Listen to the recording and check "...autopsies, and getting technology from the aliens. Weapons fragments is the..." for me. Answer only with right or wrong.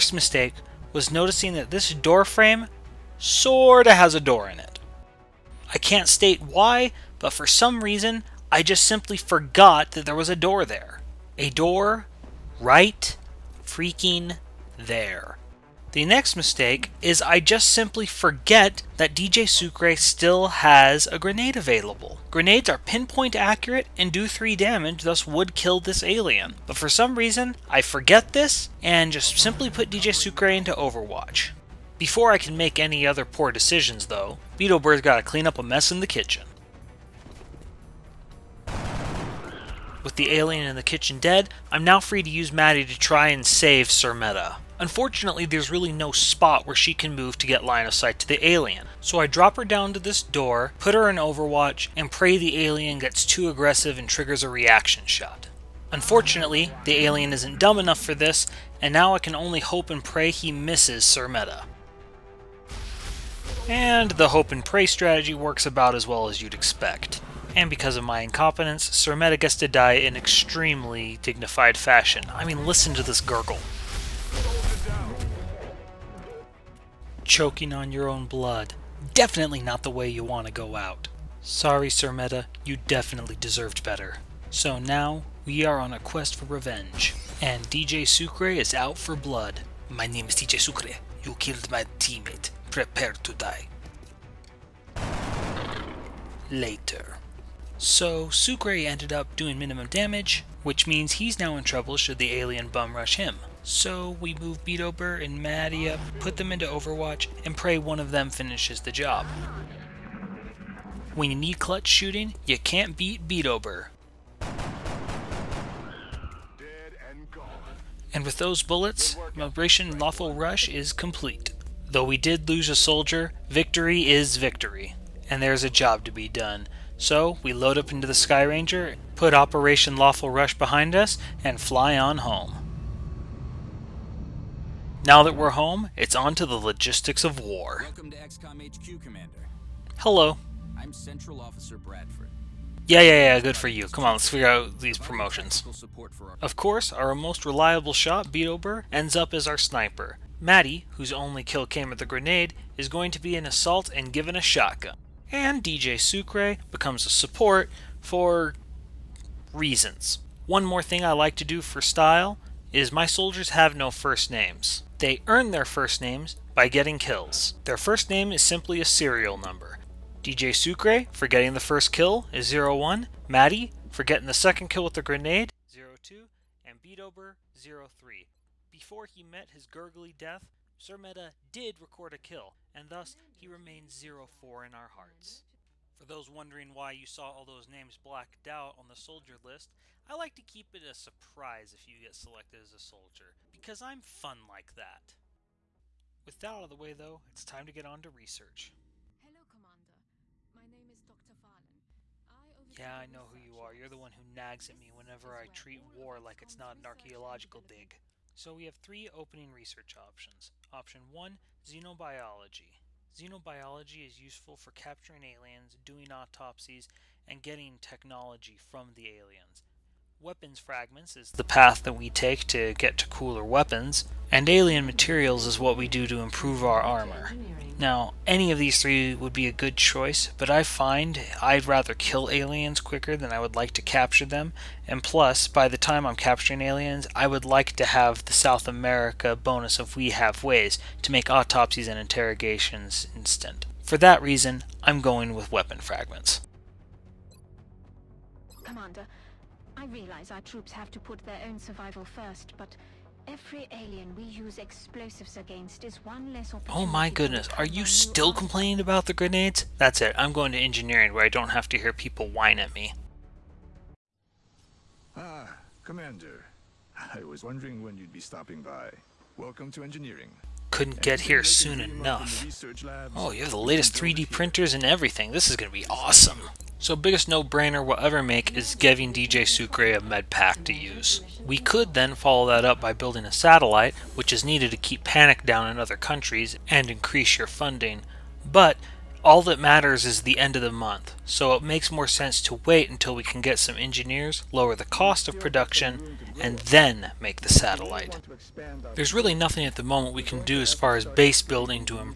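right.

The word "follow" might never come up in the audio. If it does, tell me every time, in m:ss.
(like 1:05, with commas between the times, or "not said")
4:42.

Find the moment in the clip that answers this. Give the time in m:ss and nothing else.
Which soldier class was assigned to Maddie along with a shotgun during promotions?
2:33.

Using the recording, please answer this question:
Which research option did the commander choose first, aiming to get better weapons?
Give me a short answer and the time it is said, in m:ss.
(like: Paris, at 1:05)
Weapon fragments, at 4:05.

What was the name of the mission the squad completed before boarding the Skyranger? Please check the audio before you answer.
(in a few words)
Operation Lawful Rush.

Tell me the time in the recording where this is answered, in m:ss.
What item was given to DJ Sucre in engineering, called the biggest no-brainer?
4:40.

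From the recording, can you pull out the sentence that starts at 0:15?
The next mistake is I just simply forget that DJ Sucre still has a grenade available.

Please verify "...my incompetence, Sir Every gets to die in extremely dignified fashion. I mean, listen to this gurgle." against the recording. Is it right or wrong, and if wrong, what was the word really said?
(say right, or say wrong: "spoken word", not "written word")
wrong: "Meta", not "Every".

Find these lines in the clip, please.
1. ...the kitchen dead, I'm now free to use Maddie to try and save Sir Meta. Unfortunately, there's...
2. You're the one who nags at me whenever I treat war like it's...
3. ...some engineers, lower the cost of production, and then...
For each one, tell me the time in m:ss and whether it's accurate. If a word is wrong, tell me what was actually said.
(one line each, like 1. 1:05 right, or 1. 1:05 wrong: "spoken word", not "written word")
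1. 0:40 right
2. 3:23 right
3. 4:53 right.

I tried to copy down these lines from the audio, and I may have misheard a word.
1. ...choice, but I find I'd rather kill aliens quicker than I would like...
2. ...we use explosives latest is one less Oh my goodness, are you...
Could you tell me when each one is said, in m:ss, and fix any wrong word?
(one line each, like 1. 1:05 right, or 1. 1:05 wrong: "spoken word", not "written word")
1. 3:49 right
2. 4:14 wrong: "against", not "latest".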